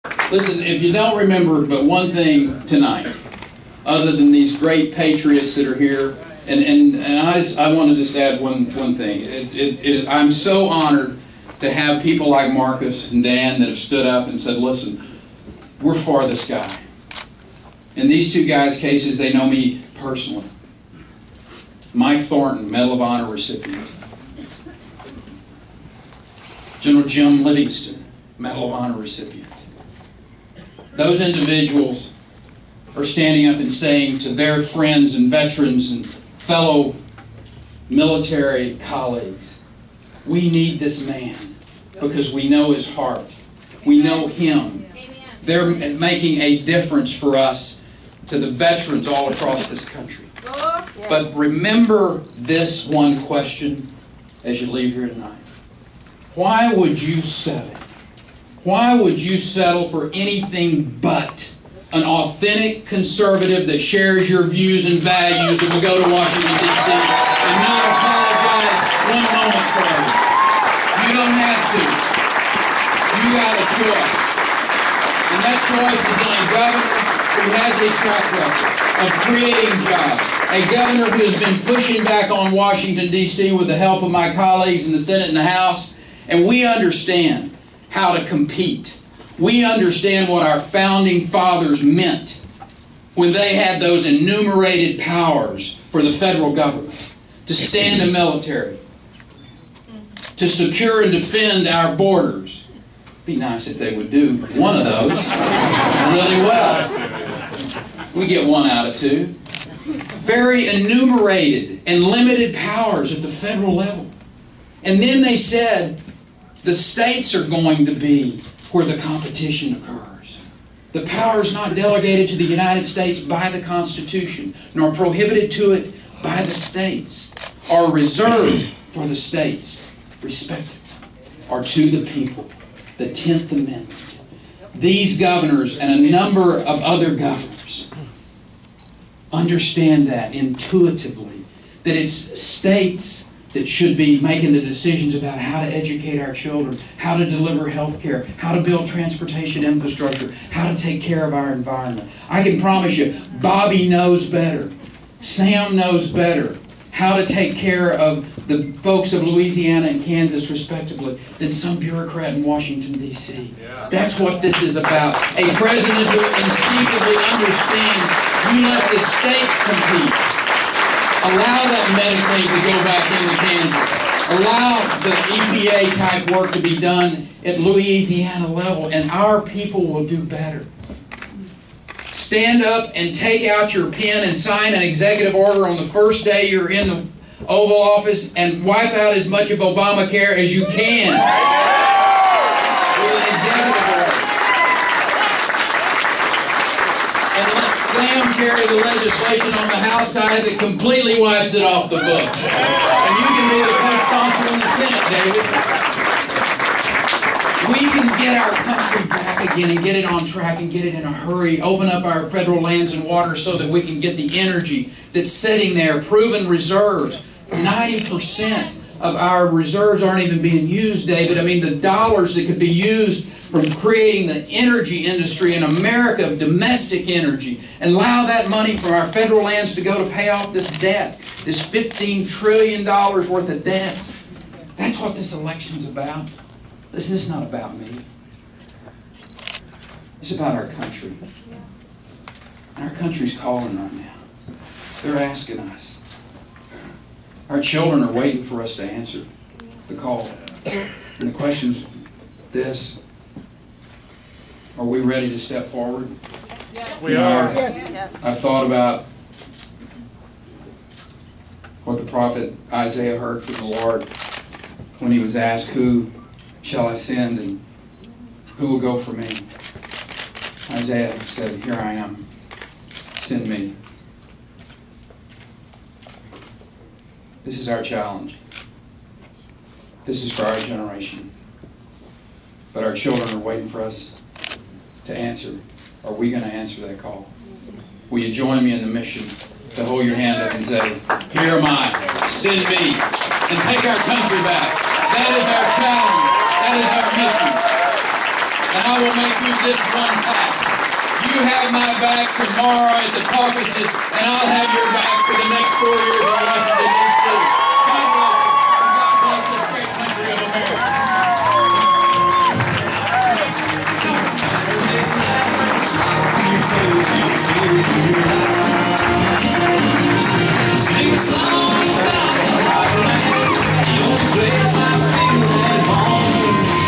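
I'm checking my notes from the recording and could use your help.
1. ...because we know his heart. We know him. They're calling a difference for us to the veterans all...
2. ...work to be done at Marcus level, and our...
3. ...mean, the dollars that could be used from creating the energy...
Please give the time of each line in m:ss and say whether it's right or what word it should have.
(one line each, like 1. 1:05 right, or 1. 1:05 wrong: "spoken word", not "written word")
1. 0:41 wrong: "making", not "calling"
2. 2:56 wrong: "Louisiana", not "Marcus"
3. 3:41 right.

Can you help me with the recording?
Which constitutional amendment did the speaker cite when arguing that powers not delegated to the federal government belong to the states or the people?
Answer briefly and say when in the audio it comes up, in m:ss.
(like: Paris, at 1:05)
10th Amendment, at 2:12.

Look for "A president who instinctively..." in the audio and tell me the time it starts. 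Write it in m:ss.
2:45.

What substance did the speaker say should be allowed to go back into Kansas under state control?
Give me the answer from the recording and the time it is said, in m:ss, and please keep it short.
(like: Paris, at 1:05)
methane, at 2:52.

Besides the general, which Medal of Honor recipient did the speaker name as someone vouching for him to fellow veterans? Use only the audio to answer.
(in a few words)
Mike Thornton.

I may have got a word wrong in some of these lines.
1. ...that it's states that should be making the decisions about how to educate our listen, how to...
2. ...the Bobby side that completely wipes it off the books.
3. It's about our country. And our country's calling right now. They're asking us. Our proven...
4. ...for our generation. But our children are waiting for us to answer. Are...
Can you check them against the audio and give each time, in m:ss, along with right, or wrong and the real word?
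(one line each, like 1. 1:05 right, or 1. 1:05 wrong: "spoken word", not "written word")
1. 2:21 wrong: "children", not "listen"
2. 3:19 wrong: "House", not "Bobby"
3. 4:00 wrong: "children", not "proven"
4. 4:40 right.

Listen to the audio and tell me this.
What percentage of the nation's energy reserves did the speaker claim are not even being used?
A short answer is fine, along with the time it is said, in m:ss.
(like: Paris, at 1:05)
90 percent, at 3:37.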